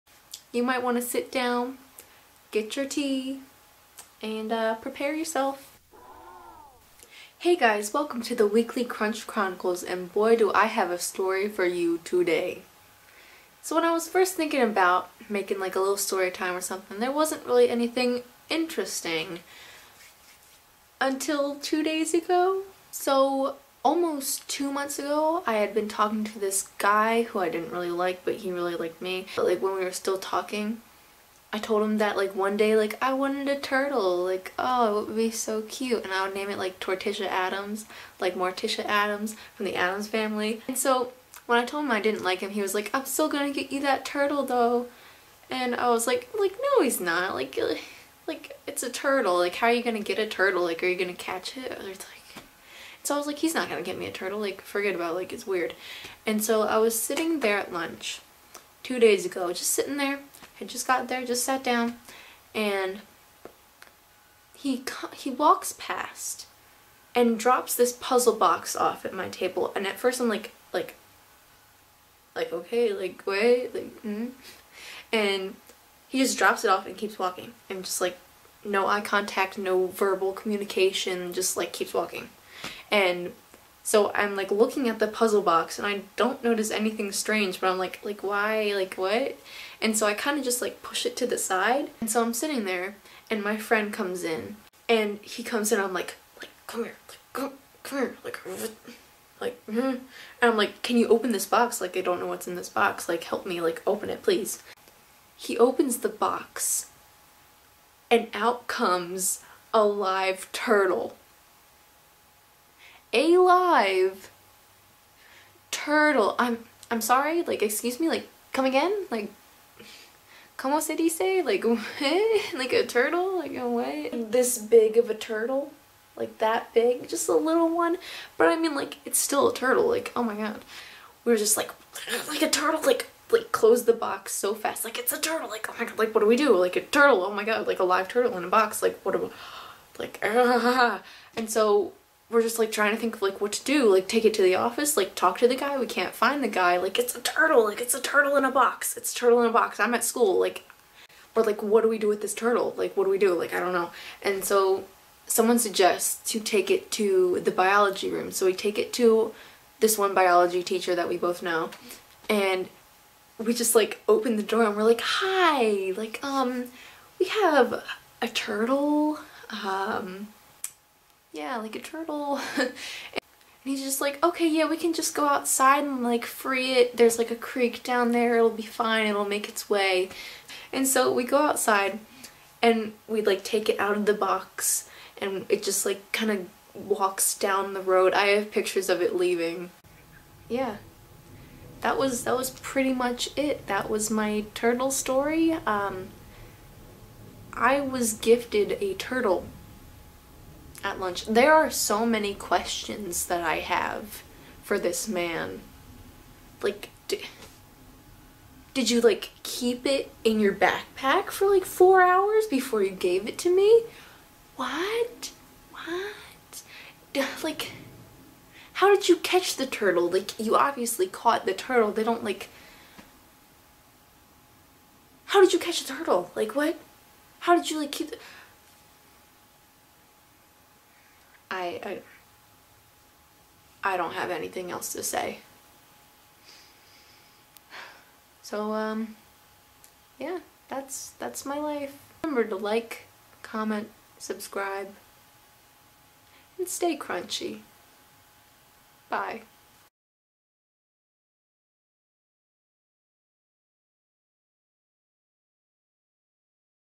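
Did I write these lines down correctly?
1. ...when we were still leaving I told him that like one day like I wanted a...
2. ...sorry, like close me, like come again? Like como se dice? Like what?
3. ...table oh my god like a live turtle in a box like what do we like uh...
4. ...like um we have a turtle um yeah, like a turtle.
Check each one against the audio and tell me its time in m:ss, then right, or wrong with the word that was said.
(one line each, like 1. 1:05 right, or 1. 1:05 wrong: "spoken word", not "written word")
1. 0:29 wrong: "talking", not "leaving"
2. 1:57 wrong: "excuse", not "close"
3. 2:16 wrong: "turtle", not "table"
4. 2:45 right.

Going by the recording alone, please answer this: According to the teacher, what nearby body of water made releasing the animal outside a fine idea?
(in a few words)
A creek.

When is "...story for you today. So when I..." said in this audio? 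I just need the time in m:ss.
0:10.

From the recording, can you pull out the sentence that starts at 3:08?
I have pictures of it leaving.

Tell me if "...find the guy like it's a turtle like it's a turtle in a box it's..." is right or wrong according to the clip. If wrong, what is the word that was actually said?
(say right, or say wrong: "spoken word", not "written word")
right.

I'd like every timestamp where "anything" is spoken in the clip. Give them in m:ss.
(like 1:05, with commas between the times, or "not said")
0:17, 1:26, 3:54.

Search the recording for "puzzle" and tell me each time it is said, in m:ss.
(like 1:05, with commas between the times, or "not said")
1:07, 1:25.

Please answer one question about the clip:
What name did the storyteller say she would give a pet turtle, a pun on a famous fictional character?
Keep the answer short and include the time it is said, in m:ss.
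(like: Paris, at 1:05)
Torticia Addams, at 0:36.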